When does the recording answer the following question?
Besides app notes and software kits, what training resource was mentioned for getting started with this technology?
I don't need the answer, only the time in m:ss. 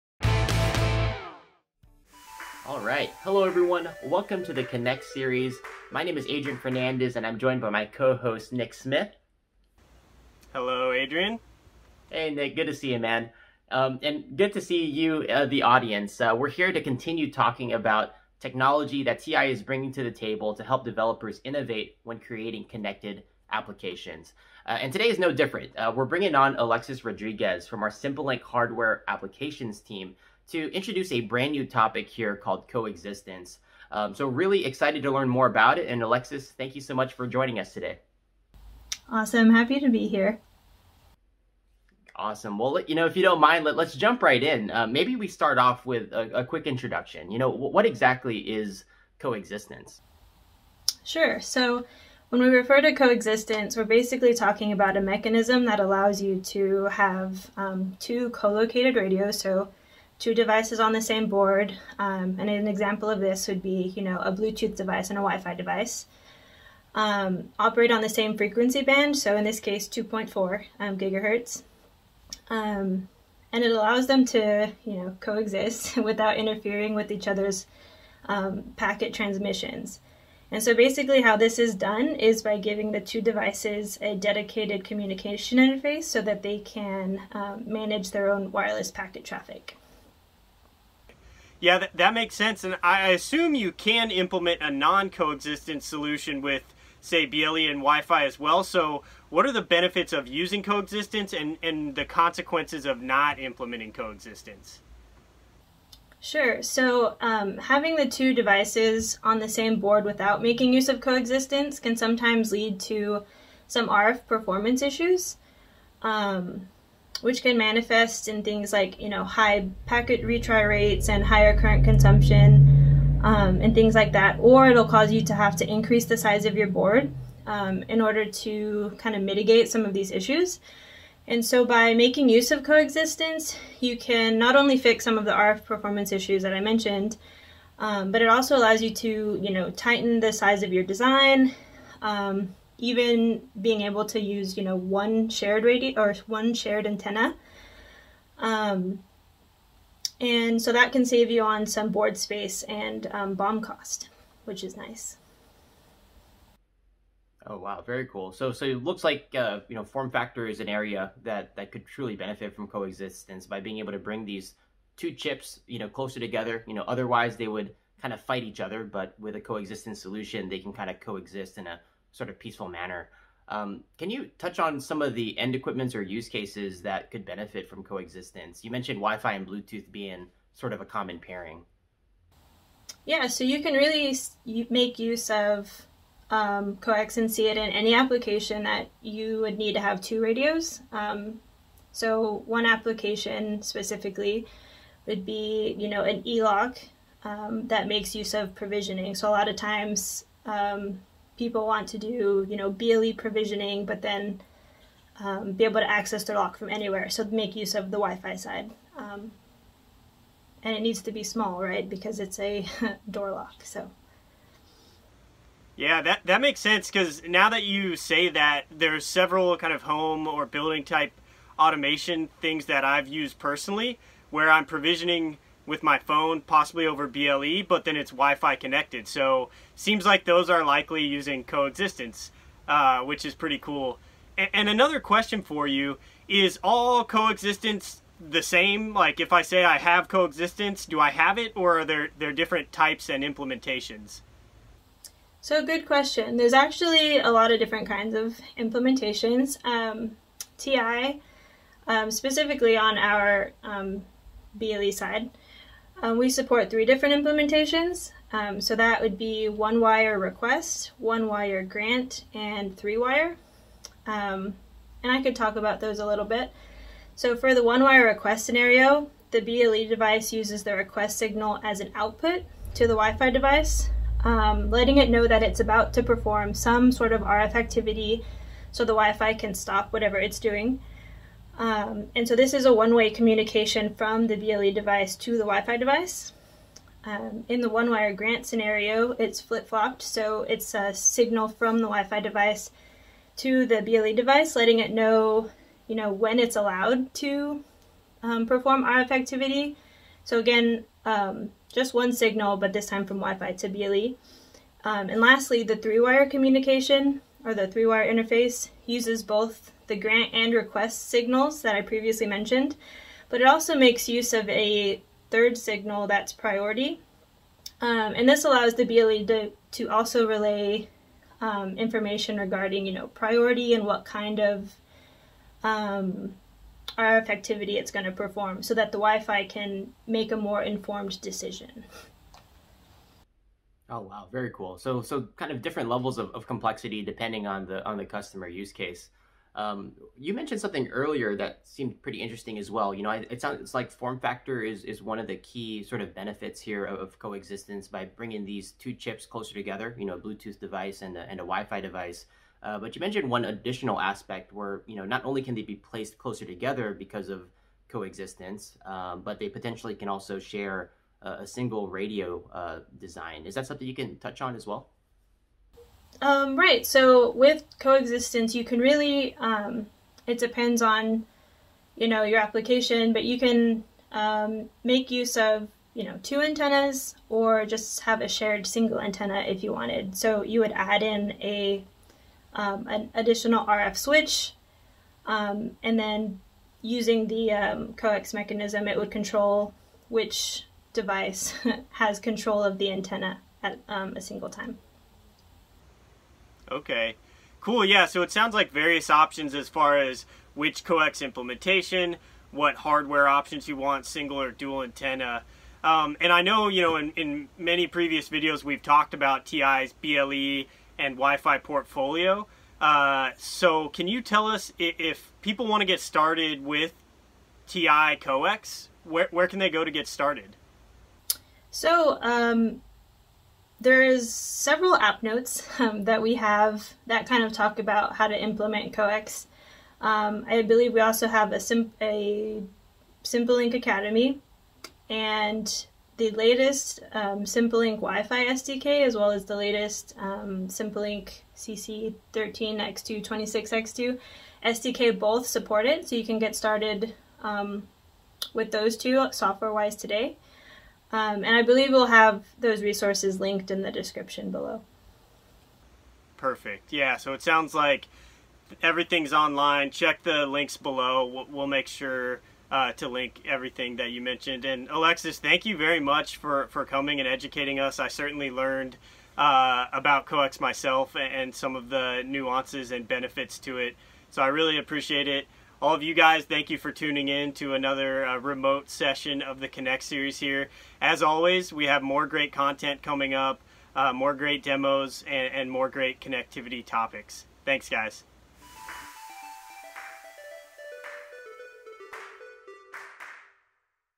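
7:13.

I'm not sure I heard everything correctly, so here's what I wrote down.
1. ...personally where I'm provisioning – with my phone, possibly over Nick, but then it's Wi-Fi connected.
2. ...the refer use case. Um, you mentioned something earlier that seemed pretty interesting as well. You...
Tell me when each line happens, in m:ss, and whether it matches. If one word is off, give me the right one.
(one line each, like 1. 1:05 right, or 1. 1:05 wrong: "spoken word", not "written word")
1. 3:43 wrong: "BLE", not "Nick"
2. 5:37 wrong: "customer", not "refer".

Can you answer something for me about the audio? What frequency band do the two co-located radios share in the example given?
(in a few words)
2.4 gigahertz.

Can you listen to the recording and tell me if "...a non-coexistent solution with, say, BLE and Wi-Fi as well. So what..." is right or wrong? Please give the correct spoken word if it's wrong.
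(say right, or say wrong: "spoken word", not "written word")
right.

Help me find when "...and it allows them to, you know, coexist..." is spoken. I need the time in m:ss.
1:13.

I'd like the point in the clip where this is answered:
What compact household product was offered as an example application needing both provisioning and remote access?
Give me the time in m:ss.
3:33.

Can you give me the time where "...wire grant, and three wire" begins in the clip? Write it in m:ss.
4:21.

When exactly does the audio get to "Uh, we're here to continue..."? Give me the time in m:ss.
0:16.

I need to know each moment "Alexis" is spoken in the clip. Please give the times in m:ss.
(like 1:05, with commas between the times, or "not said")
0:26, 0:36, 7:44.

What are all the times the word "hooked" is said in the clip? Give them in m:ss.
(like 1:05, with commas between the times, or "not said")
not said.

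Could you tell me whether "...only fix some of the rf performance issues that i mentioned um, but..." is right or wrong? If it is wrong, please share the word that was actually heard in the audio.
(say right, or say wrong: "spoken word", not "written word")
right.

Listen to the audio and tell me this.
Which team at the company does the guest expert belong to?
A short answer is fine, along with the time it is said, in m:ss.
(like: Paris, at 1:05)
SimpleLink hardware applications, at 0:27.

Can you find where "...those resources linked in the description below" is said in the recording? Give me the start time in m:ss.
7:32.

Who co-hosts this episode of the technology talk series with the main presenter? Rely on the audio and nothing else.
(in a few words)
Nick Smith.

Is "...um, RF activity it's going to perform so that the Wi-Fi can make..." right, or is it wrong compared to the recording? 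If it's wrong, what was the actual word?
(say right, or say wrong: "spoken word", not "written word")
right.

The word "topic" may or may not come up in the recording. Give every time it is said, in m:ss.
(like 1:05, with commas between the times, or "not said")
0:31, 8:06.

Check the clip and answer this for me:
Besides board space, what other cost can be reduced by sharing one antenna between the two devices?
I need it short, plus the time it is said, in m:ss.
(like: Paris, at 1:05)
BOM cost, at 2:33.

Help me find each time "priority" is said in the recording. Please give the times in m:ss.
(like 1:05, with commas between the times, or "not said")
5:16, 5:23.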